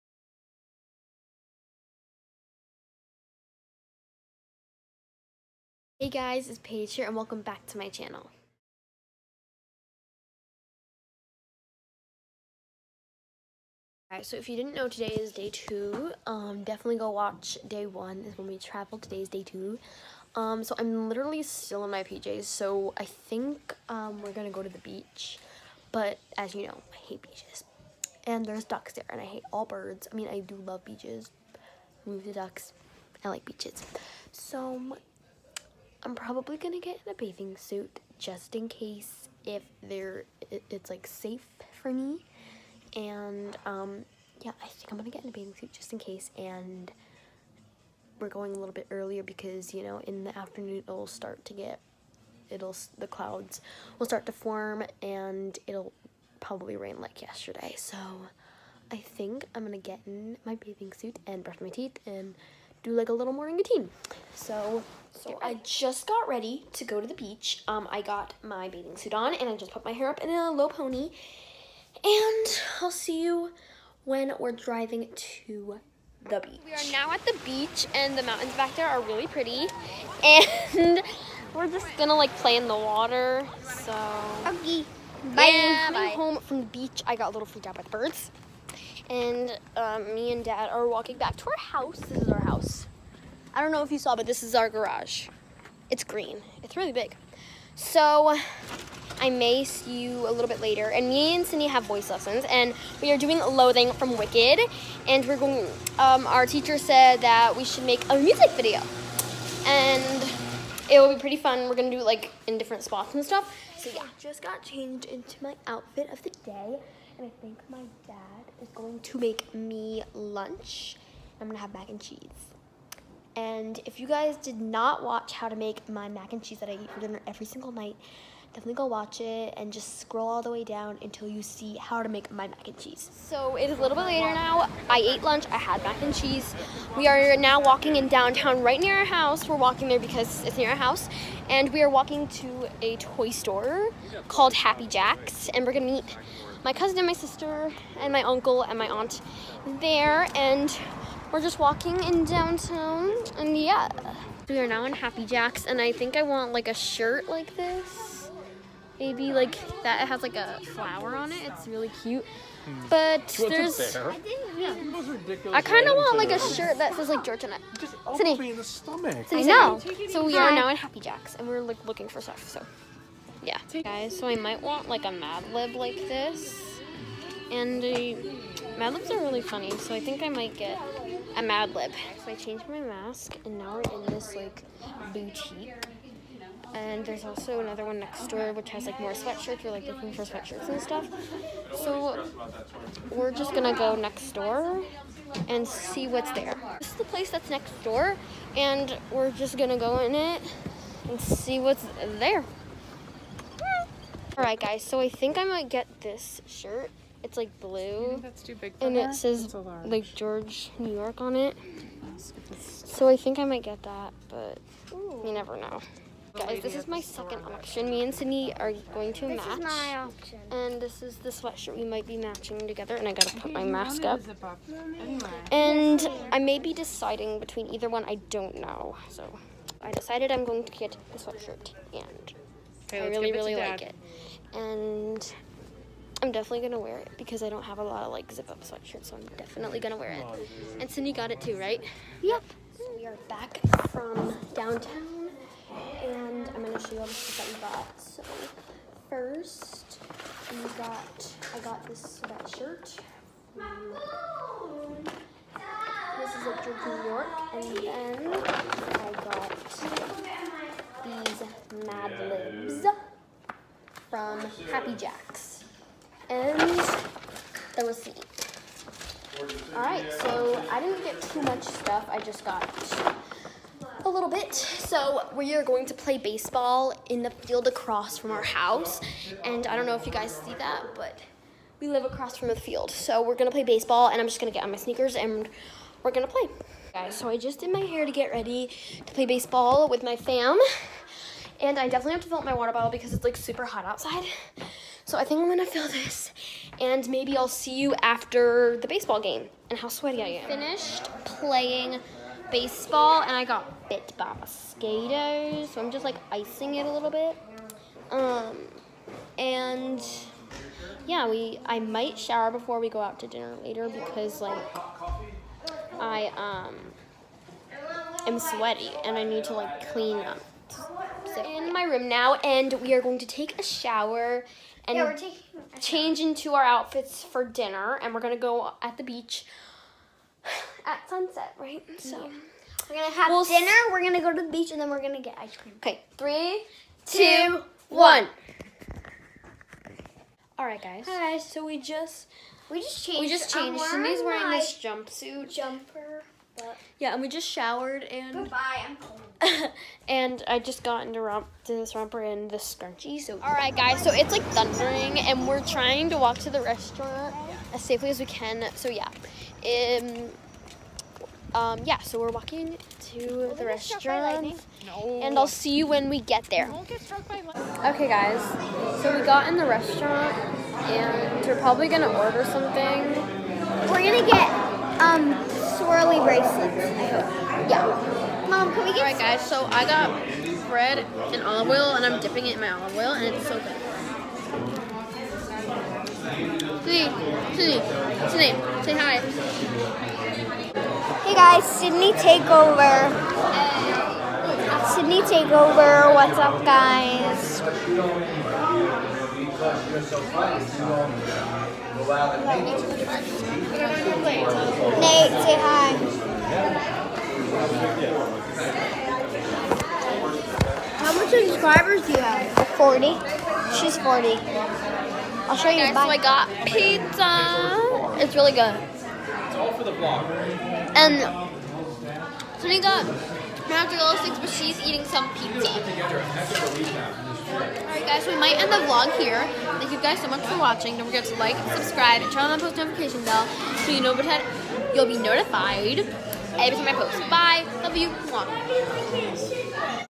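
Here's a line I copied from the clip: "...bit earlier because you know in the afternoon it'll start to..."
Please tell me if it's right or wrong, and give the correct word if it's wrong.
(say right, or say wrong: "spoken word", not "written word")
right.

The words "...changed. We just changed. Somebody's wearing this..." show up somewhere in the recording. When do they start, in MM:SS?
05:43.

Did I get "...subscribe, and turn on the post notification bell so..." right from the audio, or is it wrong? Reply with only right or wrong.
right.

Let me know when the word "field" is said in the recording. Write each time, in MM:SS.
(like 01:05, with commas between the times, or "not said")
04:37, 04:42.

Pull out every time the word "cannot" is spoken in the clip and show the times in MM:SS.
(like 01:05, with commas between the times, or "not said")
not said.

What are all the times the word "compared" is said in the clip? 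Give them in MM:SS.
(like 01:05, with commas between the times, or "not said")
not said.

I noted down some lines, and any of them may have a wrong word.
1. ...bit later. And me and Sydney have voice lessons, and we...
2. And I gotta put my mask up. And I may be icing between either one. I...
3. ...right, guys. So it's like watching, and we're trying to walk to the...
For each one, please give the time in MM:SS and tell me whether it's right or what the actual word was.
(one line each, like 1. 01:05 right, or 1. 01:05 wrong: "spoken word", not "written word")
1. 01:40 right
2. 03:42 wrong: "deciding", not "icing"
3. 05:53 wrong: "thundering", not "watching".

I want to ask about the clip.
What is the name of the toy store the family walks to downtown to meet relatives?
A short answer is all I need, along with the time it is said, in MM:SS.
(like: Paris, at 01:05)
Happy Jack's, at 02:24.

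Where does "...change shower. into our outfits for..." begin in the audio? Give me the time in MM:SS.
05:25.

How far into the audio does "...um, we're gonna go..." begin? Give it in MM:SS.
00:23.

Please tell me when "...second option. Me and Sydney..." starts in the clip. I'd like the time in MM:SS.
03:37.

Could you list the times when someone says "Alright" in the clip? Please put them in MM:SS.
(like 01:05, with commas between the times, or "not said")
00:14, 03:24, 04:29, 06:18.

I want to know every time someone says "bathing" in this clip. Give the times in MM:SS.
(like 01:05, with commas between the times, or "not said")
00:37, 00:45, 01:00, 01:08.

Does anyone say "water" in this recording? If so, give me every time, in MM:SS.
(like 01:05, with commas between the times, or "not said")
01:22, 04:52.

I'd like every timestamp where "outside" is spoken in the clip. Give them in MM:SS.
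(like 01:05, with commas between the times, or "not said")
04:53.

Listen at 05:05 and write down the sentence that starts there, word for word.
So I'm just like icing it a little bit.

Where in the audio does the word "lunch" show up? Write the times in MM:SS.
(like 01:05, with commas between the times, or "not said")
02:00, 02:15.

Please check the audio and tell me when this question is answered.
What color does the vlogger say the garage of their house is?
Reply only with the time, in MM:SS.
01:35.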